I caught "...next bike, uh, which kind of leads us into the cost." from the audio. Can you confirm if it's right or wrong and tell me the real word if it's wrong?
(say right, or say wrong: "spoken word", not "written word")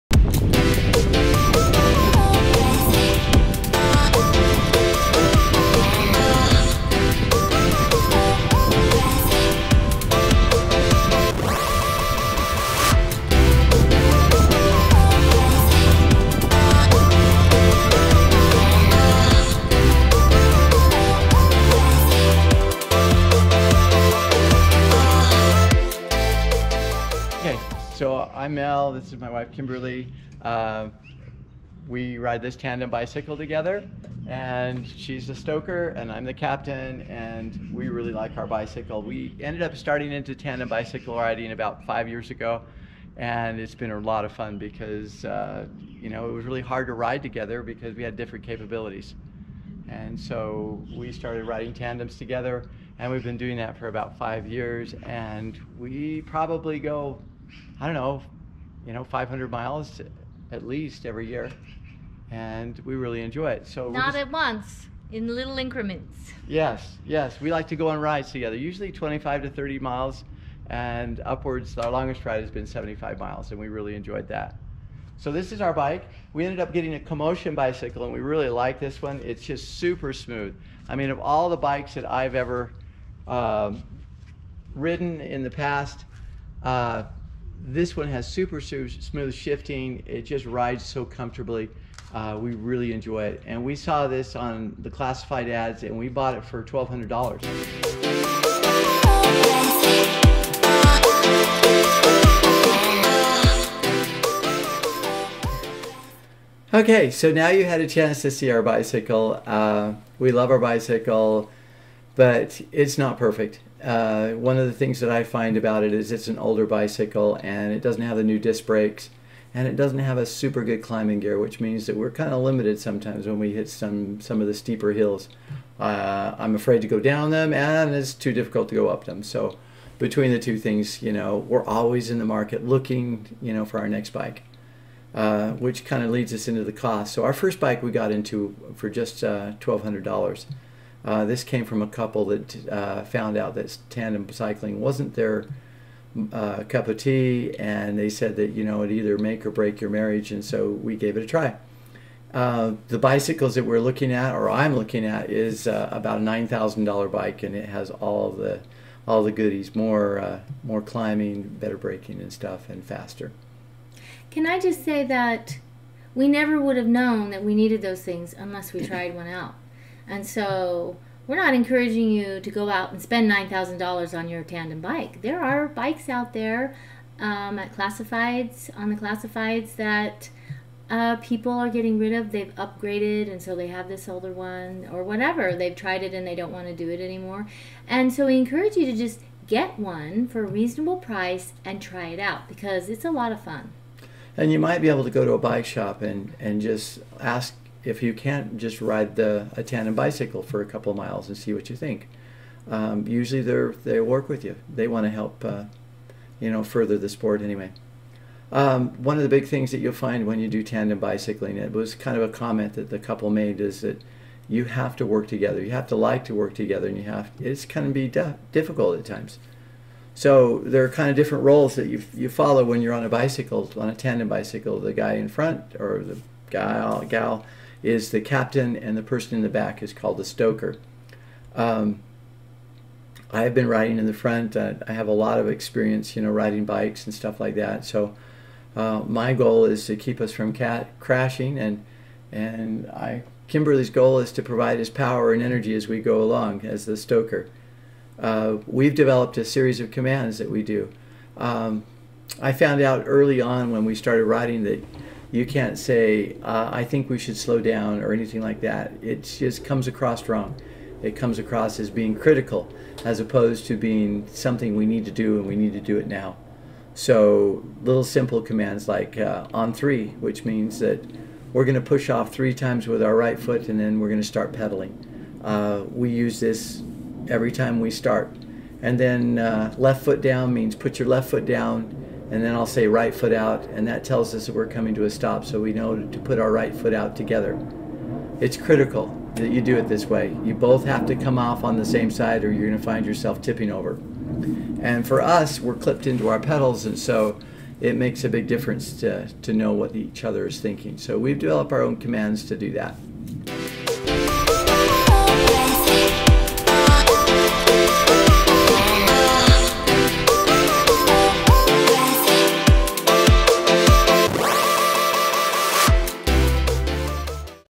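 right.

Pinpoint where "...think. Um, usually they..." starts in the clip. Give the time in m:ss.
3:21.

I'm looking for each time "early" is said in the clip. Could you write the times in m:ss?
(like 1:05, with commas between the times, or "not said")
4:13.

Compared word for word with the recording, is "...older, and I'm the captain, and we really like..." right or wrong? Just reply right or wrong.
wrong.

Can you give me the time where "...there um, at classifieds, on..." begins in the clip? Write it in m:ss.
2:56.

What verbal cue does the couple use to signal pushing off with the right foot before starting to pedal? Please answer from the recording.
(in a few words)
On three.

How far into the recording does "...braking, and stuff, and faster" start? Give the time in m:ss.
2:41.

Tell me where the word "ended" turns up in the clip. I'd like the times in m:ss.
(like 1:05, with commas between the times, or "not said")
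0:39, 1:16.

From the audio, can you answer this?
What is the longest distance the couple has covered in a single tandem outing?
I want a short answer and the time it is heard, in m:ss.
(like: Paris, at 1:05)
75 miles, at 1:12.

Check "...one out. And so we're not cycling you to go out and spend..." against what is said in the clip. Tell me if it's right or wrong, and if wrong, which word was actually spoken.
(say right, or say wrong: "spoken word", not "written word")
wrong: "encouraging", not "cycling".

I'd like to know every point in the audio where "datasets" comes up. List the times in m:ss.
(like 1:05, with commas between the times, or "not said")
not said.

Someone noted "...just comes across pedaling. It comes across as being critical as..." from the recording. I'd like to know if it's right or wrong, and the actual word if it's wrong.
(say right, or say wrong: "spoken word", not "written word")
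wrong: "wrong", not "pedaling".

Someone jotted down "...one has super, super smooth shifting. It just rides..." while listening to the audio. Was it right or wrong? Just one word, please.
right.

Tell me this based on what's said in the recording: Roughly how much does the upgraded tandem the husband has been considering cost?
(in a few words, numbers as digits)
$9,000.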